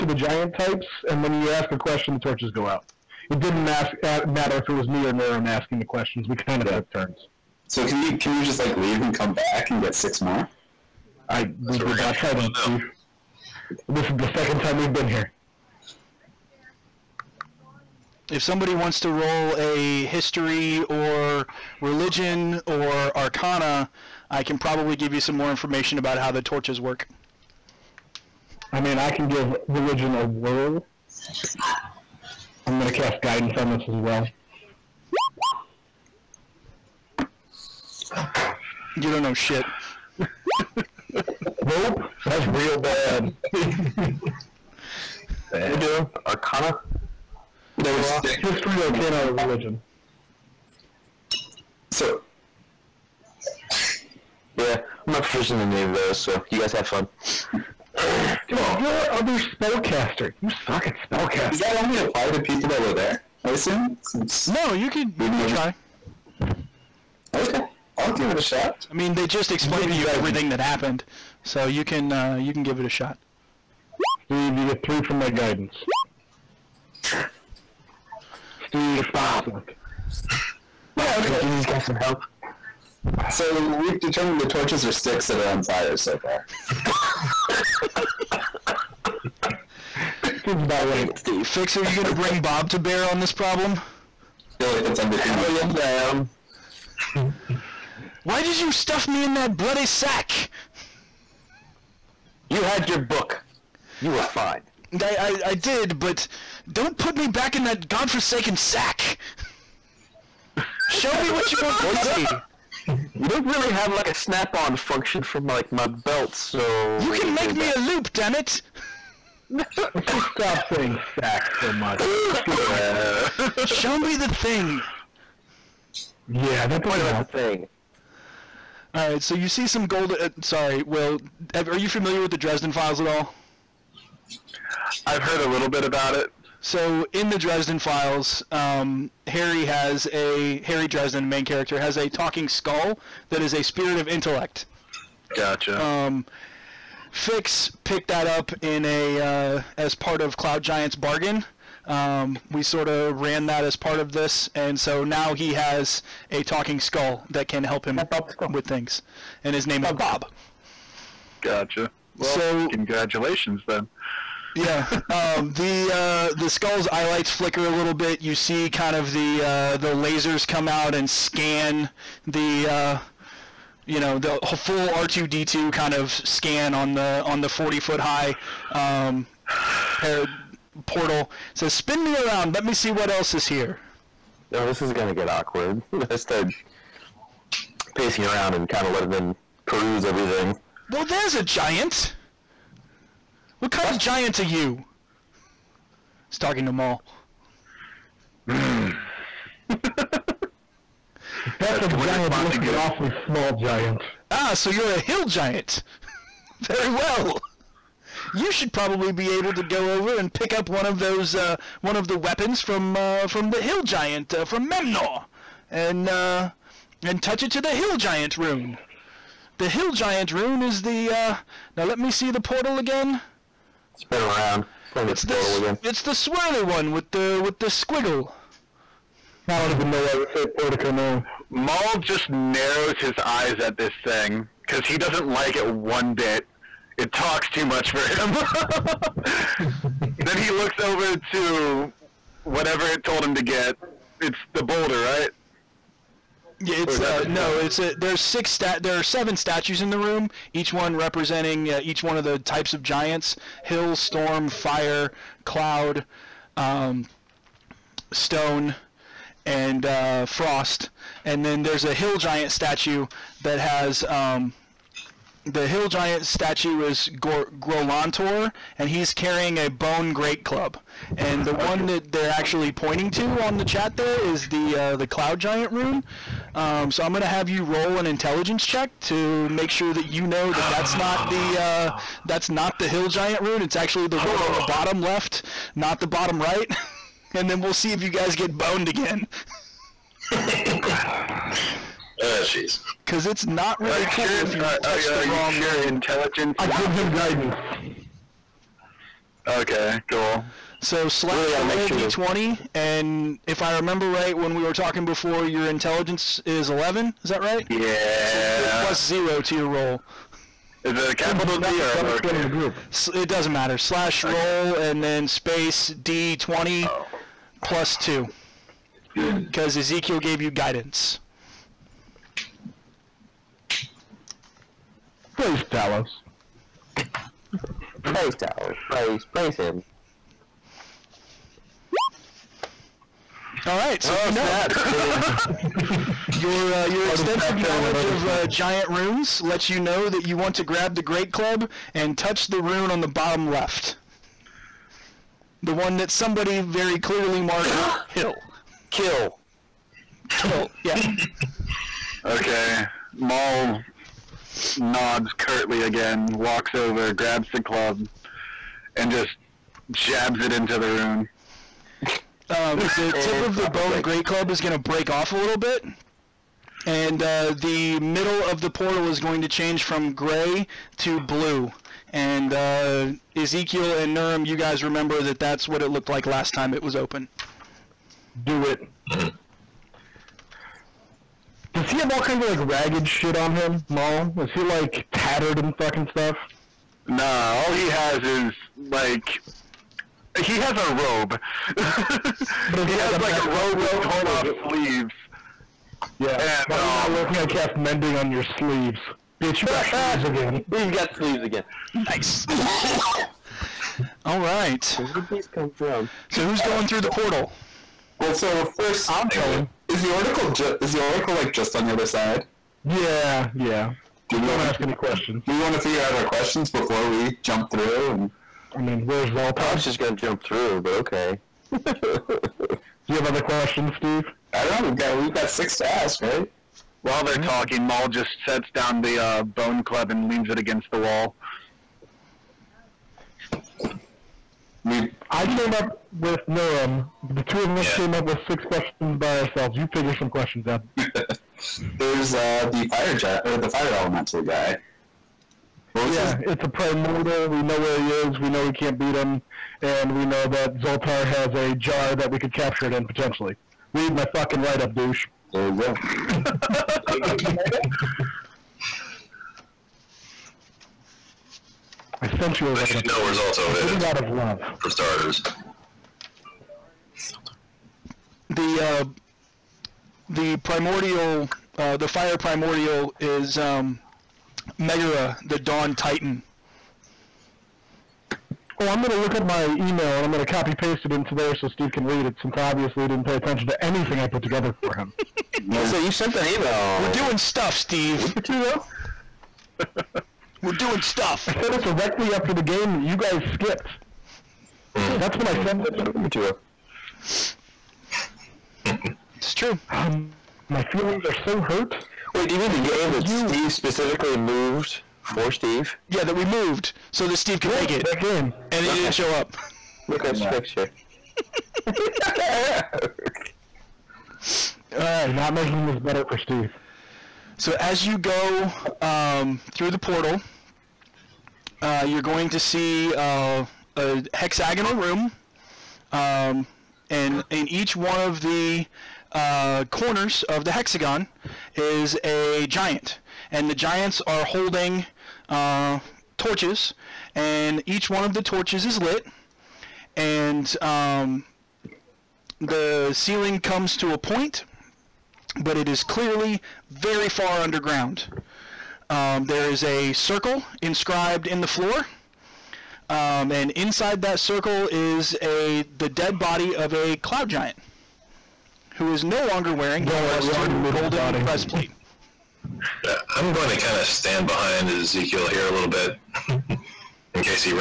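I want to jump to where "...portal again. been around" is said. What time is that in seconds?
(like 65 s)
222 s.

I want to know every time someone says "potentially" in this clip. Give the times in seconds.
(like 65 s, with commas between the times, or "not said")
453 s.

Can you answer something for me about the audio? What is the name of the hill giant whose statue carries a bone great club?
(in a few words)
Grolantor.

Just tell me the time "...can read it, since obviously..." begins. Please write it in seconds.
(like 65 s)
481 s.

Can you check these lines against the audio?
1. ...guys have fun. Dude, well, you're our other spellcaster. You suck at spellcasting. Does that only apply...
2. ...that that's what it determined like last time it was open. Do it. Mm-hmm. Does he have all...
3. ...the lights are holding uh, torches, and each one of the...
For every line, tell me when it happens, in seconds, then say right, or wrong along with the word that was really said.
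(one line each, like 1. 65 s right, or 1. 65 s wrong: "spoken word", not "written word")
1. 56 s right
2. 375 s wrong: "looked", not "determined"
3. 533 s wrong: "giants", not "lights".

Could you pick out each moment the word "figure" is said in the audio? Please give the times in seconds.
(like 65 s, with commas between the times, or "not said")
415 s, 439 s.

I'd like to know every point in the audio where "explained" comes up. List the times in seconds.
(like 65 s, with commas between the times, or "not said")
69 s.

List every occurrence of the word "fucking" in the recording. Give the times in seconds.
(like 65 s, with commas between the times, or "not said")
385 s, 454 s.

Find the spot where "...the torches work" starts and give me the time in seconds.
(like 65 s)
26 s.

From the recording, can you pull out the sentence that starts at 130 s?
Uh, sorry, Will, are you familiar with the Dresden Files at all?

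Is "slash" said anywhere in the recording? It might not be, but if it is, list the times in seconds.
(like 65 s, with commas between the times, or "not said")
301 s, 313 s.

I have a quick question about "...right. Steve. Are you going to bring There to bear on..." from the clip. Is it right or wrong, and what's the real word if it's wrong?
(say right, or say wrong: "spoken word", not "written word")
wrong: "Bob", not "There".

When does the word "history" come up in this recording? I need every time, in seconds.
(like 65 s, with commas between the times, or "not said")
20 s, 48 s.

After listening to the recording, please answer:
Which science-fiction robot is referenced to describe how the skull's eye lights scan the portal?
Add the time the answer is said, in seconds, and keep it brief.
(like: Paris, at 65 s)
R2-D2, at 174 s.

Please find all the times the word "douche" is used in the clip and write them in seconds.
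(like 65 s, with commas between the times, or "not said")
454 s.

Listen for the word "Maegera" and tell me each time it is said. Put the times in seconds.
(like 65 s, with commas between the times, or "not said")
474 s.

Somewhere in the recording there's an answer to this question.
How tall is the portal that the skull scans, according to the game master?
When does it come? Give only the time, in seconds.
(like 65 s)
177 s.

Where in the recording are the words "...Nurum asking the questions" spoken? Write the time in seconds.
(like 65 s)
5 s.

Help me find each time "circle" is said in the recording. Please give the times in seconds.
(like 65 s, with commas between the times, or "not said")
550 s, 554 s.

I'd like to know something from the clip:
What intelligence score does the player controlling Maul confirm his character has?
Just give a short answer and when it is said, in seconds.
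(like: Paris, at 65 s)
11, at 306 s.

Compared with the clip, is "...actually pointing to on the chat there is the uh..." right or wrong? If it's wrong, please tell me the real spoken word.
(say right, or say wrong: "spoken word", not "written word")
right.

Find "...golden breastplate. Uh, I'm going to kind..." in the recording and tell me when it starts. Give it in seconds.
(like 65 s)
560 s.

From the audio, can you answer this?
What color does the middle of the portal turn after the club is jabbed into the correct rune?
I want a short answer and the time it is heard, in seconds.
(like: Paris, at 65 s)
blue, at 371 s.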